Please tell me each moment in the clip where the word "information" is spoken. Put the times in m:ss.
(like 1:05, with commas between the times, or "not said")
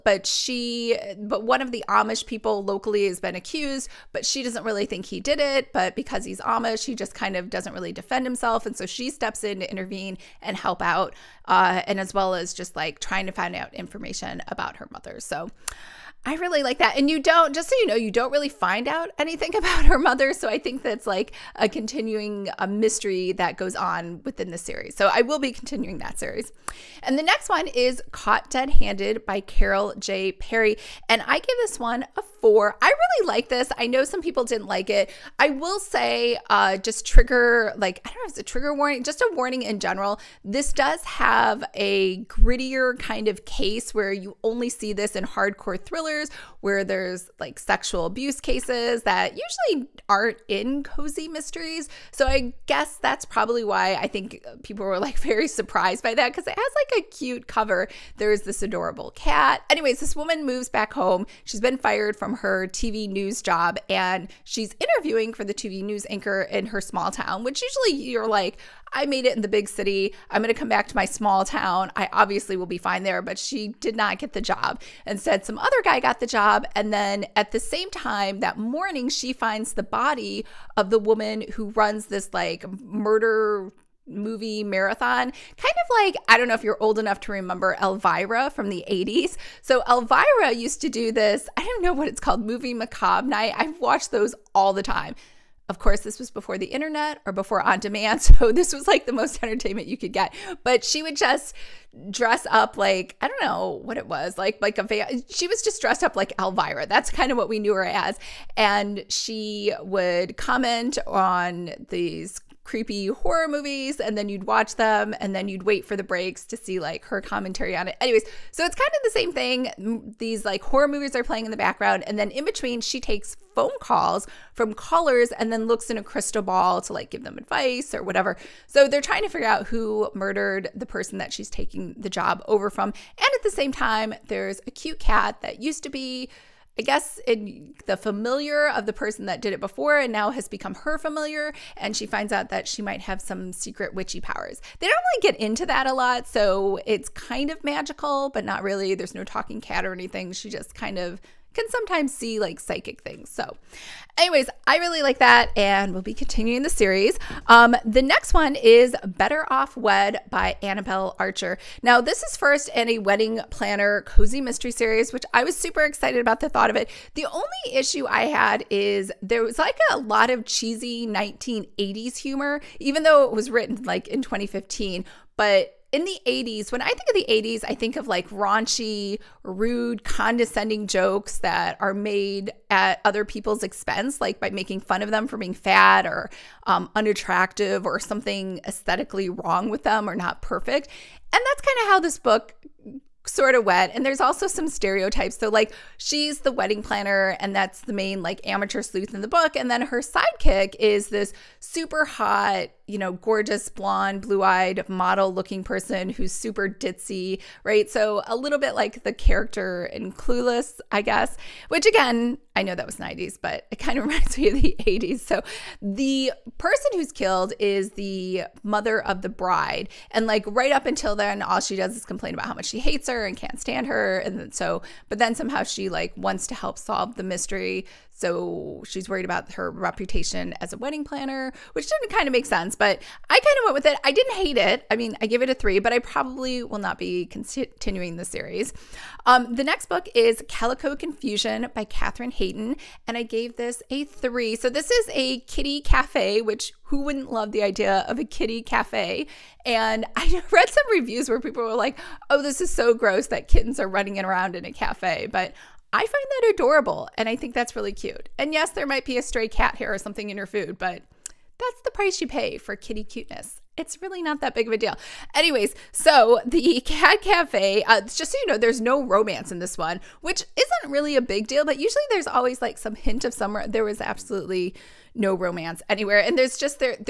0:13.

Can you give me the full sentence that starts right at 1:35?
Of course, this was before the internet or before on demand.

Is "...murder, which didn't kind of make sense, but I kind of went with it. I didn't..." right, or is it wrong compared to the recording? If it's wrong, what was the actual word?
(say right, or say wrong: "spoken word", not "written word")
wrong: "planner", not "murder".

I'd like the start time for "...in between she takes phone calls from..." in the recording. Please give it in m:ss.
2:02.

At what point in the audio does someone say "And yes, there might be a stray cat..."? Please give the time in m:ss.
4:18.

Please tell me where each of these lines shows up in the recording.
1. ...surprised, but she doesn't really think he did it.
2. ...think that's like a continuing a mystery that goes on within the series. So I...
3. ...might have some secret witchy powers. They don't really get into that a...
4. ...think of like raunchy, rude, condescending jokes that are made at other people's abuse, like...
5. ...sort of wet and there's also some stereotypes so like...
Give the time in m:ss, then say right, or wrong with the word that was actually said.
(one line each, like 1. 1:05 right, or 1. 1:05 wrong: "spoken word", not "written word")
1. 0:03 wrong: "accused", not "surprised"
2. 0:20 right
3. 2:22 right
4. 2:57 wrong: "expense", not "abuse"
5. 3:13 right.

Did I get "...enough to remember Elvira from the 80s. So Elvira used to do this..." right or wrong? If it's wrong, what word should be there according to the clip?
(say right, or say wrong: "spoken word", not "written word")
right.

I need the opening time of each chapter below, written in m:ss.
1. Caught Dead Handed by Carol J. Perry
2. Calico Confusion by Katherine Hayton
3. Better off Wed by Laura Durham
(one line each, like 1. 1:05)
1. 0:28
2. 4:00
3. 2:38.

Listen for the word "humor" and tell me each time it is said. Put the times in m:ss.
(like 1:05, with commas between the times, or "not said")
2:52.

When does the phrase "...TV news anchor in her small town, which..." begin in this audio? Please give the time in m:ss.
1:05.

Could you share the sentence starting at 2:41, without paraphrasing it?
Now, this is first in a wedding planner cozy mystery series, which I was super excited about the thought of it.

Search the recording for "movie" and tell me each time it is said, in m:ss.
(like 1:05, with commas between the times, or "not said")
1:24, 1:32, 1:53, 2:00.